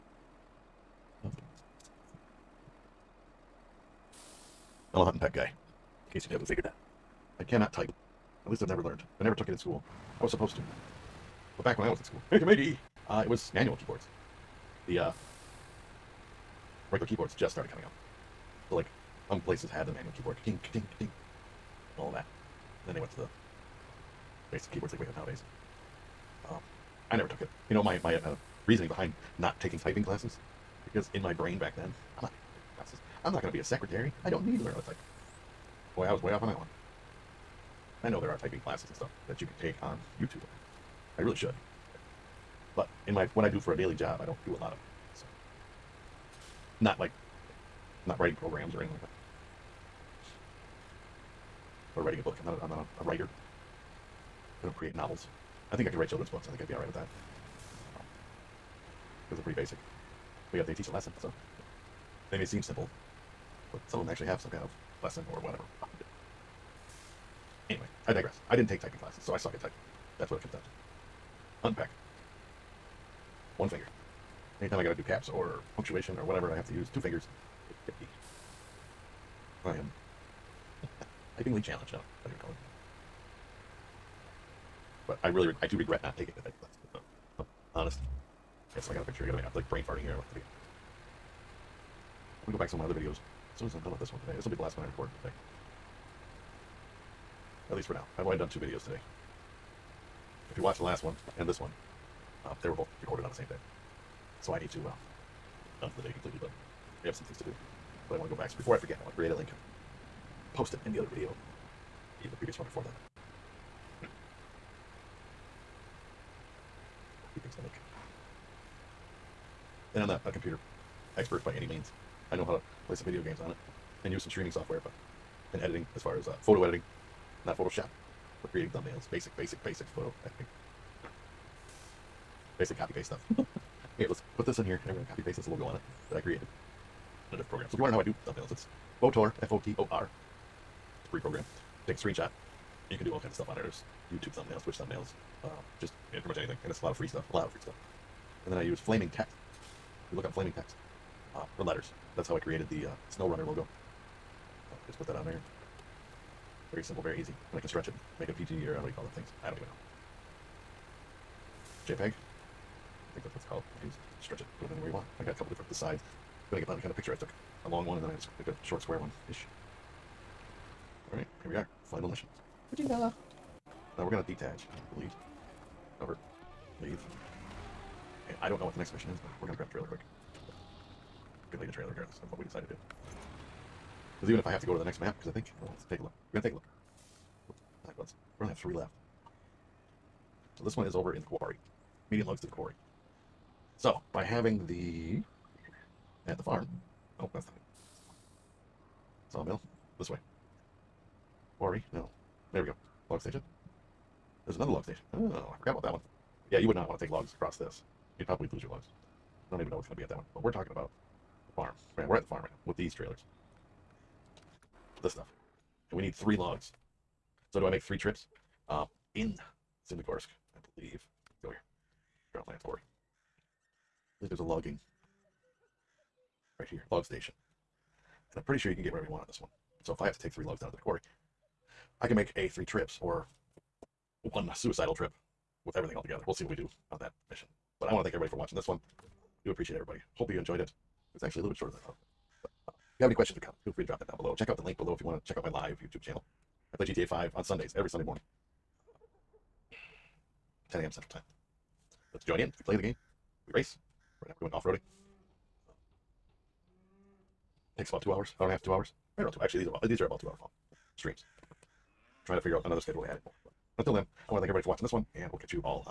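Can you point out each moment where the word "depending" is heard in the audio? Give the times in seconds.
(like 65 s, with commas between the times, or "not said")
166 s.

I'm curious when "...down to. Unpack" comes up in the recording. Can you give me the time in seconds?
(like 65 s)
70 s.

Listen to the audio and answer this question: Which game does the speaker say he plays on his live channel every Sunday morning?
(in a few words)
GTA 5.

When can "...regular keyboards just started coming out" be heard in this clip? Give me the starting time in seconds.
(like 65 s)
16 s.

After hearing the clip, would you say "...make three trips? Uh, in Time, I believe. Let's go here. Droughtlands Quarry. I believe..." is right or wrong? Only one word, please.
wrong.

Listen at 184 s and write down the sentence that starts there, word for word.
Because even if I have to go to the next map, because I think, oh, let's take a look.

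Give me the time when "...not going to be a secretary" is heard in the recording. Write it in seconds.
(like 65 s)
33 s.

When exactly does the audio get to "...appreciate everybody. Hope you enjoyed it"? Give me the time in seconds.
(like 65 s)
239 s.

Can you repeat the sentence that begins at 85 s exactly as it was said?
but I really reg- I do regret not taking it.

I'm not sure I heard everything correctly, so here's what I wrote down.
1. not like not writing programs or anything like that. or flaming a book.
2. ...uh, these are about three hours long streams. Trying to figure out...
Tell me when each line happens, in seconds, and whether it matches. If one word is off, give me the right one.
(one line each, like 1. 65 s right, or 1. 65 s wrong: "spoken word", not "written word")
1. 46 s wrong: "writing", not "flaming"
2. 259 s wrong: "two", not "three".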